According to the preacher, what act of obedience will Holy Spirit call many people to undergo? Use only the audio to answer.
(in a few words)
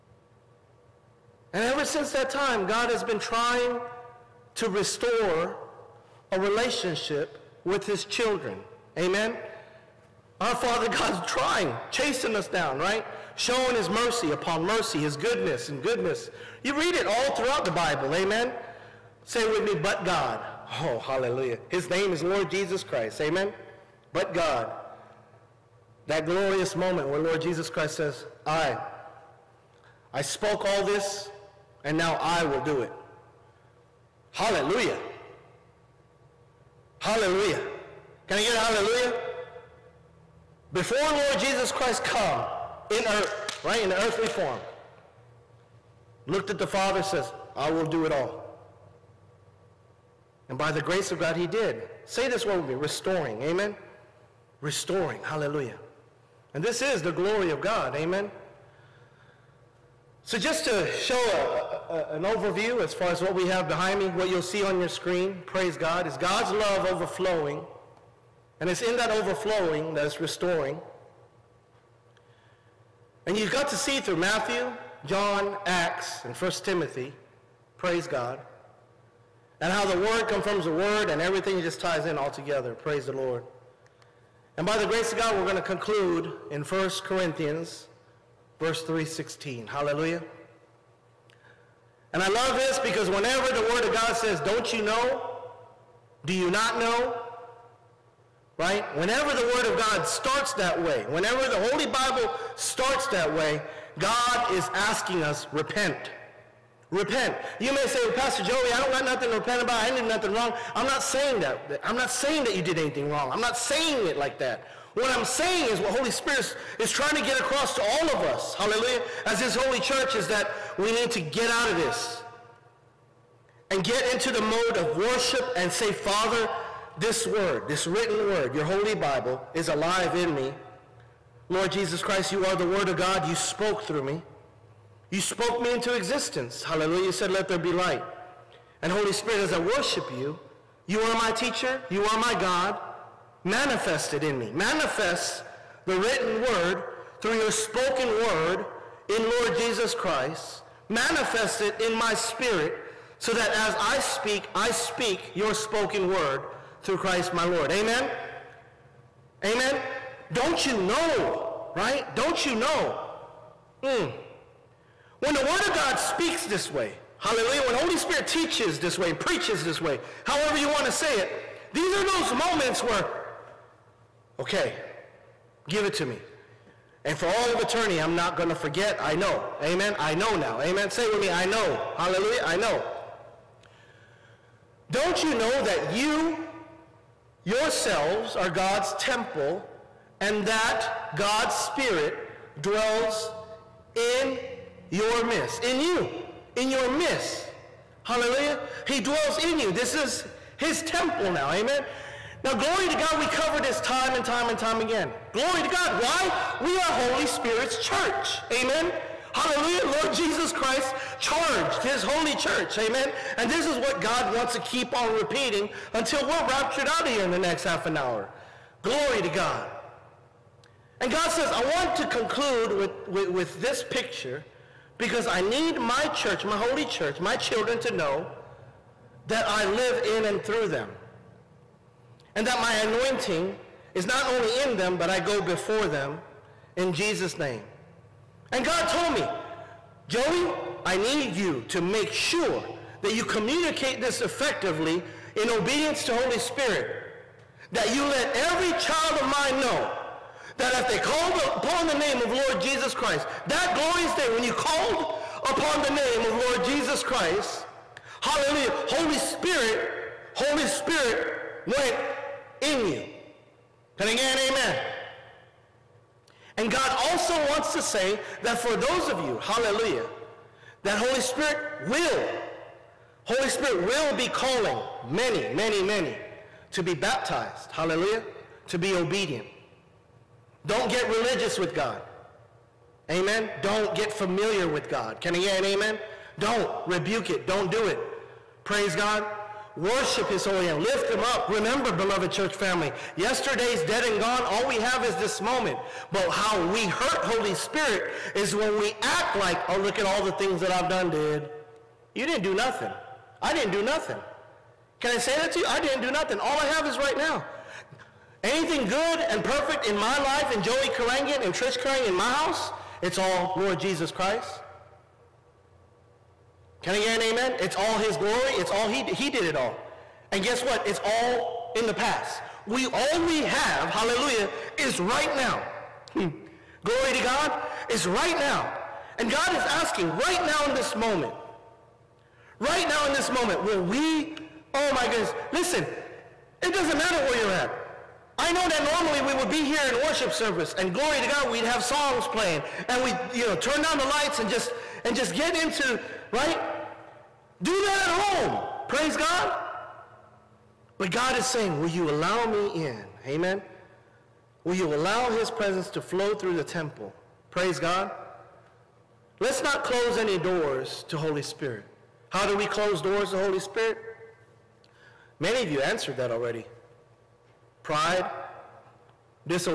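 Baptized.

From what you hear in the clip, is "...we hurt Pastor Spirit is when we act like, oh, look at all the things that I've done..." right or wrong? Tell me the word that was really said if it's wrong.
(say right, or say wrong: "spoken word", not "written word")
wrong: "Holy", not "Pastor".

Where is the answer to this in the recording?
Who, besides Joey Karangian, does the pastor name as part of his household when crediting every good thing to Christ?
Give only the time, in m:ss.
5:11.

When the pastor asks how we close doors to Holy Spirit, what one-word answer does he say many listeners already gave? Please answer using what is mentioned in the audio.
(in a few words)
Pride.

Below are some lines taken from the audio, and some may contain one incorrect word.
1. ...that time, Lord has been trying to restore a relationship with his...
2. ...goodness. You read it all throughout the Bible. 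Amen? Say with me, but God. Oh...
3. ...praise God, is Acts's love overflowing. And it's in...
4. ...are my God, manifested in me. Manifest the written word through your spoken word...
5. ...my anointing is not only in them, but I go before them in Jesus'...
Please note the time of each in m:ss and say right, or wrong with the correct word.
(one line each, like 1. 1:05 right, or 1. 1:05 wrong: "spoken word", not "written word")
1. 0:02 wrong: "God", not "Lord"
2. 0:15 right
3. 1:05 wrong: "God", not "Acts"
4. 2:22 right
5. 3:52 right.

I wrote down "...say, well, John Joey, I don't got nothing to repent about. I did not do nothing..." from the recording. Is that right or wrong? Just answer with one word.
wrong.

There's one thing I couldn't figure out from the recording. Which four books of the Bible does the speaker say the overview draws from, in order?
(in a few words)
Matthew, John, Acts, and 1 Timothy.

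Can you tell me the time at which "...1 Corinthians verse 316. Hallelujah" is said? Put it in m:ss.
1:26.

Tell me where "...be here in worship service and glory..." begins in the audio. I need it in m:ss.
5:39.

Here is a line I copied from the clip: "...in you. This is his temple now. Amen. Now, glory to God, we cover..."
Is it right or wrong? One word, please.
right.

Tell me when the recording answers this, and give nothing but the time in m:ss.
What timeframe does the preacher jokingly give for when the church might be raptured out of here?
3:37.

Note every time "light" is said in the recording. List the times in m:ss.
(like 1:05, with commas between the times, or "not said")
2:17, 5:44.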